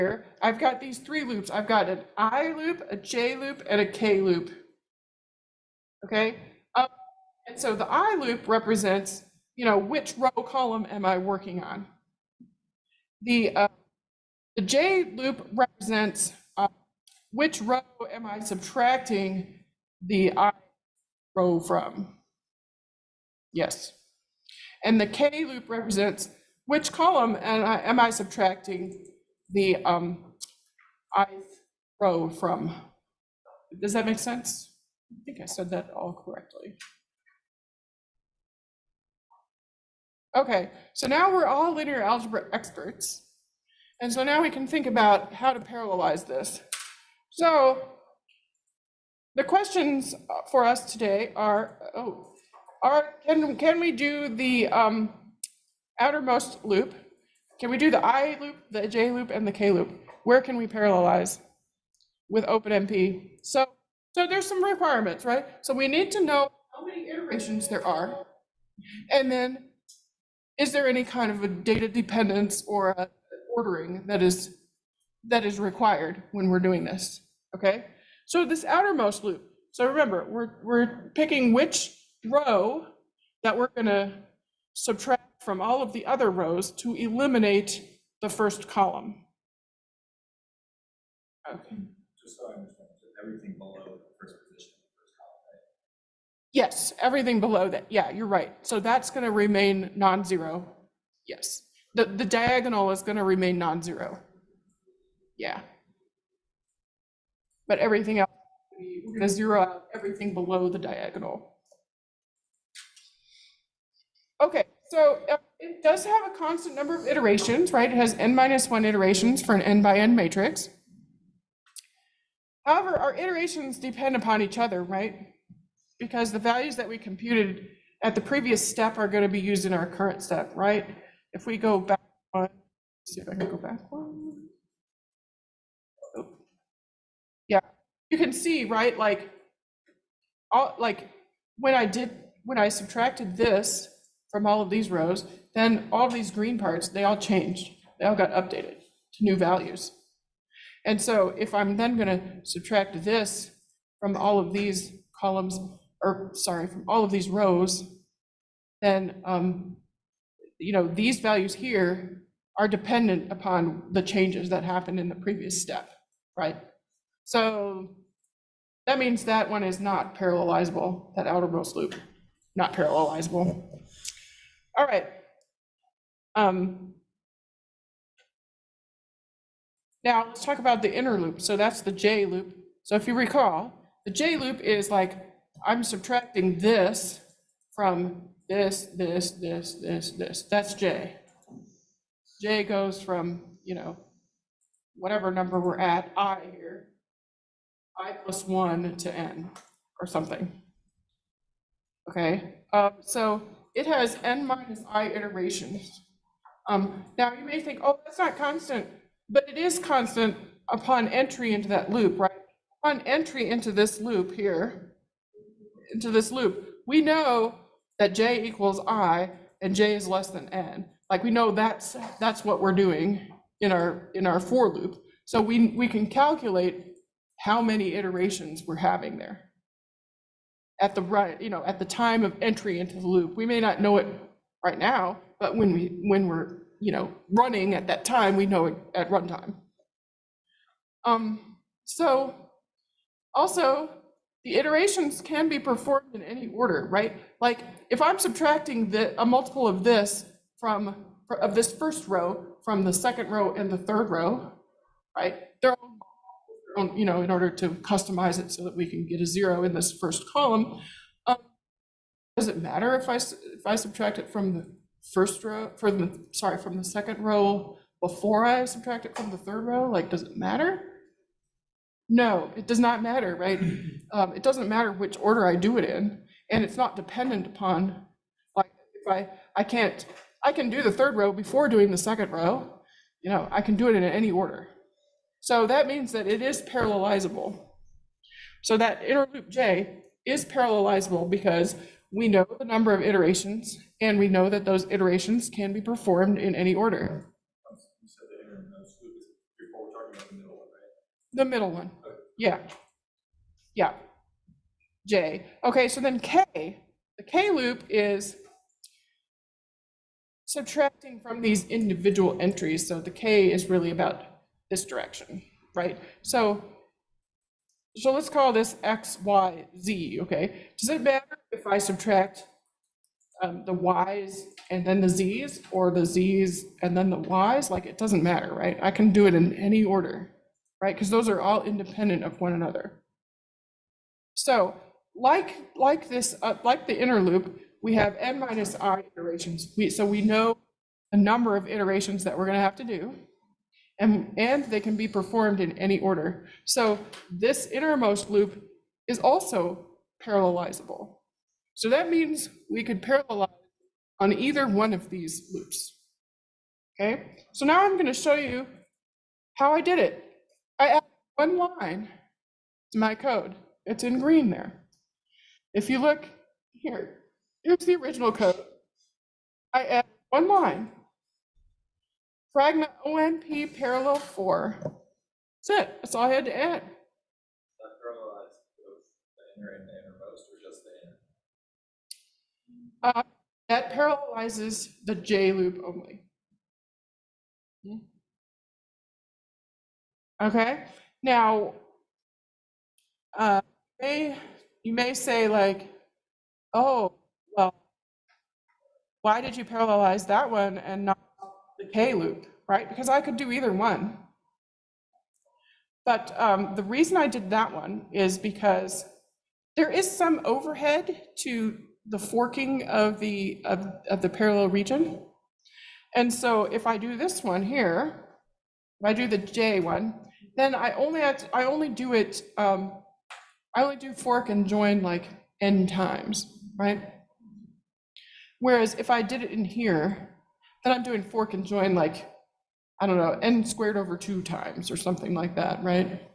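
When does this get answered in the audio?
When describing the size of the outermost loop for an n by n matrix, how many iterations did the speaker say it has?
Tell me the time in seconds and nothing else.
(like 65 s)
118 s.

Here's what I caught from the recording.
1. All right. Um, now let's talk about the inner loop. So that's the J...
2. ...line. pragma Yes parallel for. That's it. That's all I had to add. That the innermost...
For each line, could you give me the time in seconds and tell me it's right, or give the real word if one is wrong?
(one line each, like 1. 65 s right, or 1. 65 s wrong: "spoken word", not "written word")
1. 174 s right
2. 370 s wrong: "OMP", not "Yes".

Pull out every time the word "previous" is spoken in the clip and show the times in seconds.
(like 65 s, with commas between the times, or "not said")
128 s, 165 s.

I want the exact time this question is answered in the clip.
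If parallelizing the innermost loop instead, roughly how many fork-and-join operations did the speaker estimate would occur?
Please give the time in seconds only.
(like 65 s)
433 s.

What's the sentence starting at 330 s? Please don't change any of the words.
Because those are all independent of one another.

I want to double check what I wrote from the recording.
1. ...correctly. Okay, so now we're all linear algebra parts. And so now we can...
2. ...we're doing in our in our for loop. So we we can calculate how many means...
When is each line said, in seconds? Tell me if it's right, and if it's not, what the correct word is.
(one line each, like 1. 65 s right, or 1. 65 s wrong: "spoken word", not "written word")
1. 36 s wrong: "experts", not "parts"
2. 222 s wrong: "iterations", not "means".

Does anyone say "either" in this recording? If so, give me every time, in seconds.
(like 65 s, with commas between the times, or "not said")
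354 s, 403 s.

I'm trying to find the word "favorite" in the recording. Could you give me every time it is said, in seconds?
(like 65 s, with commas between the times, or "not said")
not said.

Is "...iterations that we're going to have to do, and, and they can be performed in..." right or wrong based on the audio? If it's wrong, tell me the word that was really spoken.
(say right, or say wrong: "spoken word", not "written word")
right.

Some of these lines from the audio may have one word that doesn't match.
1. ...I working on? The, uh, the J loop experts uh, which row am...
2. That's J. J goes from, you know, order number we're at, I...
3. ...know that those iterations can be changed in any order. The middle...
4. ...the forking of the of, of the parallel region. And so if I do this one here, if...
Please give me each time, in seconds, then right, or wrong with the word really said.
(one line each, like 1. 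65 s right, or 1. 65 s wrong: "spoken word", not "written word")
1. 11 s wrong: "represents", not "experts"
2. 190 s wrong: "whatever", not "order"
3. 294 s wrong: "performed", not "changed"
4. 412 s right.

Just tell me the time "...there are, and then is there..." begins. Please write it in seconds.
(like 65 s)
67 s.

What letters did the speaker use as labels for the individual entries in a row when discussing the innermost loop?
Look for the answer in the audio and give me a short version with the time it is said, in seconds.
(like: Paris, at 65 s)
X, Y, Z, at 318 s.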